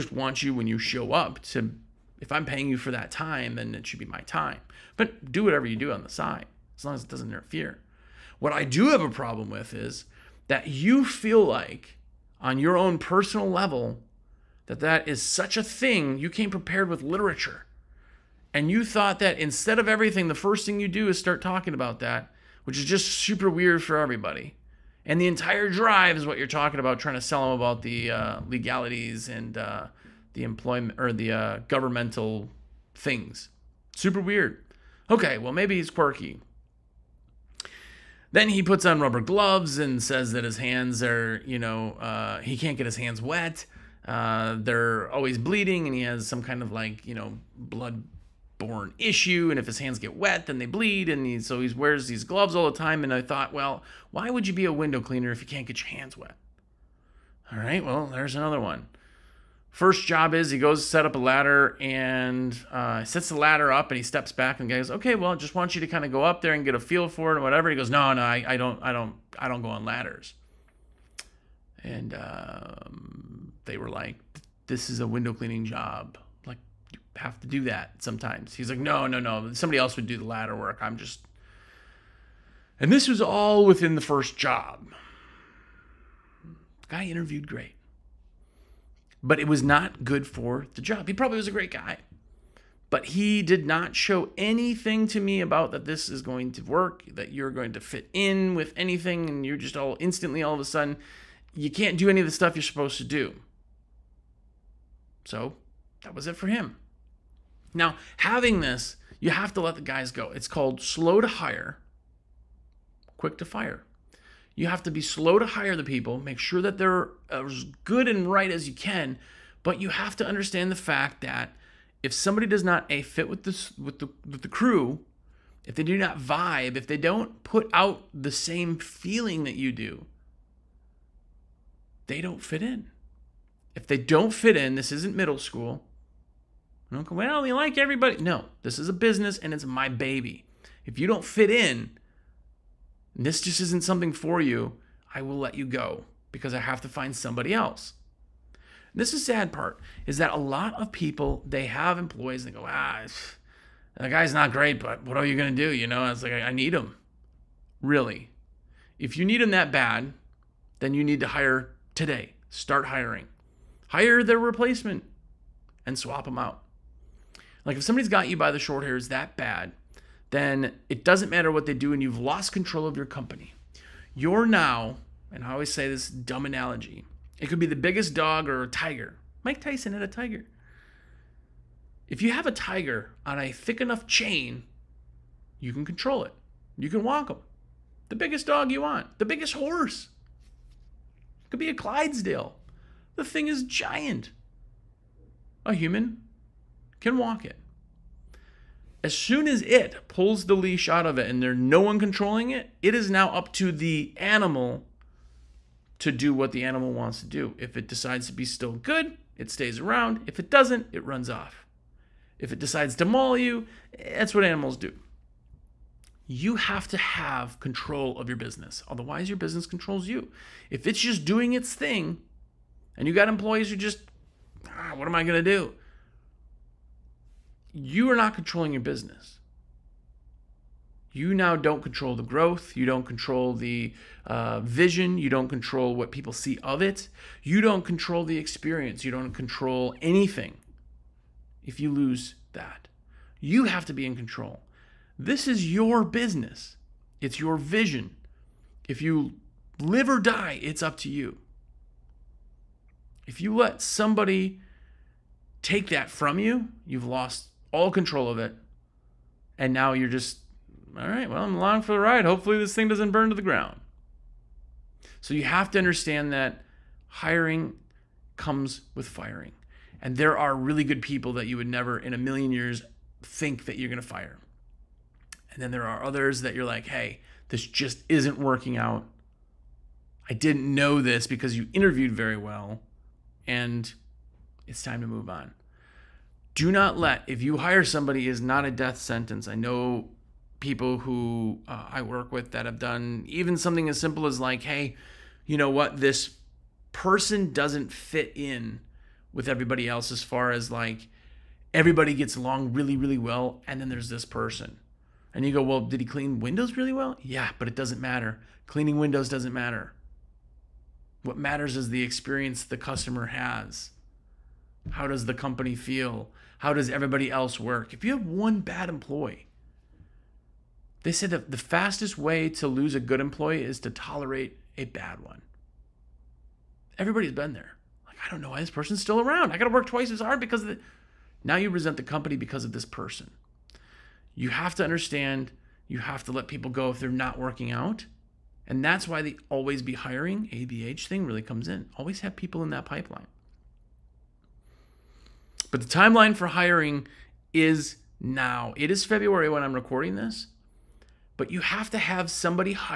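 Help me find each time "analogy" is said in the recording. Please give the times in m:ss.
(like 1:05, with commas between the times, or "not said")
2:56.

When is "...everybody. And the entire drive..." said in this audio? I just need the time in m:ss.
0:23.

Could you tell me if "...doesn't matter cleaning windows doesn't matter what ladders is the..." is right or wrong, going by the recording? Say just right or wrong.
wrong.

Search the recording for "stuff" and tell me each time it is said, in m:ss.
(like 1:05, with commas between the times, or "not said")
1:42.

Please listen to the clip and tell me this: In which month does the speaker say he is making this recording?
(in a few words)
February.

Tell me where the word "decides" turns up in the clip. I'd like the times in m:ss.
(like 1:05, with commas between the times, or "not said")
3:27, 3:32.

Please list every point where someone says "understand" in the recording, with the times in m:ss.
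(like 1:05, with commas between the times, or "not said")
2:00, 4:25, 5:34.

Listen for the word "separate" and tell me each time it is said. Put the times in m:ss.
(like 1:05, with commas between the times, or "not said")
not said.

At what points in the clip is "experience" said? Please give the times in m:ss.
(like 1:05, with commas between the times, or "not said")
3:58, 5:12.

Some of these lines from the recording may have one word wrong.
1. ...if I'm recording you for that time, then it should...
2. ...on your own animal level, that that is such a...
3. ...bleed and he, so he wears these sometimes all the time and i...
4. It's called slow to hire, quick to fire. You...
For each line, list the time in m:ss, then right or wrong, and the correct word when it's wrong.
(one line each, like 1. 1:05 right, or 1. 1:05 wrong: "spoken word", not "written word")
1. 0:02 wrong: "paying", not "recording"
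2. 0:12 wrong: "personal", not "animal"
3. 0:50 wrong: "gloves", not "sometimes"
4. 1:50 right.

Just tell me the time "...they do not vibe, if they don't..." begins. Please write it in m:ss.
2:05.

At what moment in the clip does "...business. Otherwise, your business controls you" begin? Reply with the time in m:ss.
3:38.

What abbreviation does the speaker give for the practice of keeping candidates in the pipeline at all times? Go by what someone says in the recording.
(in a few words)
ABH.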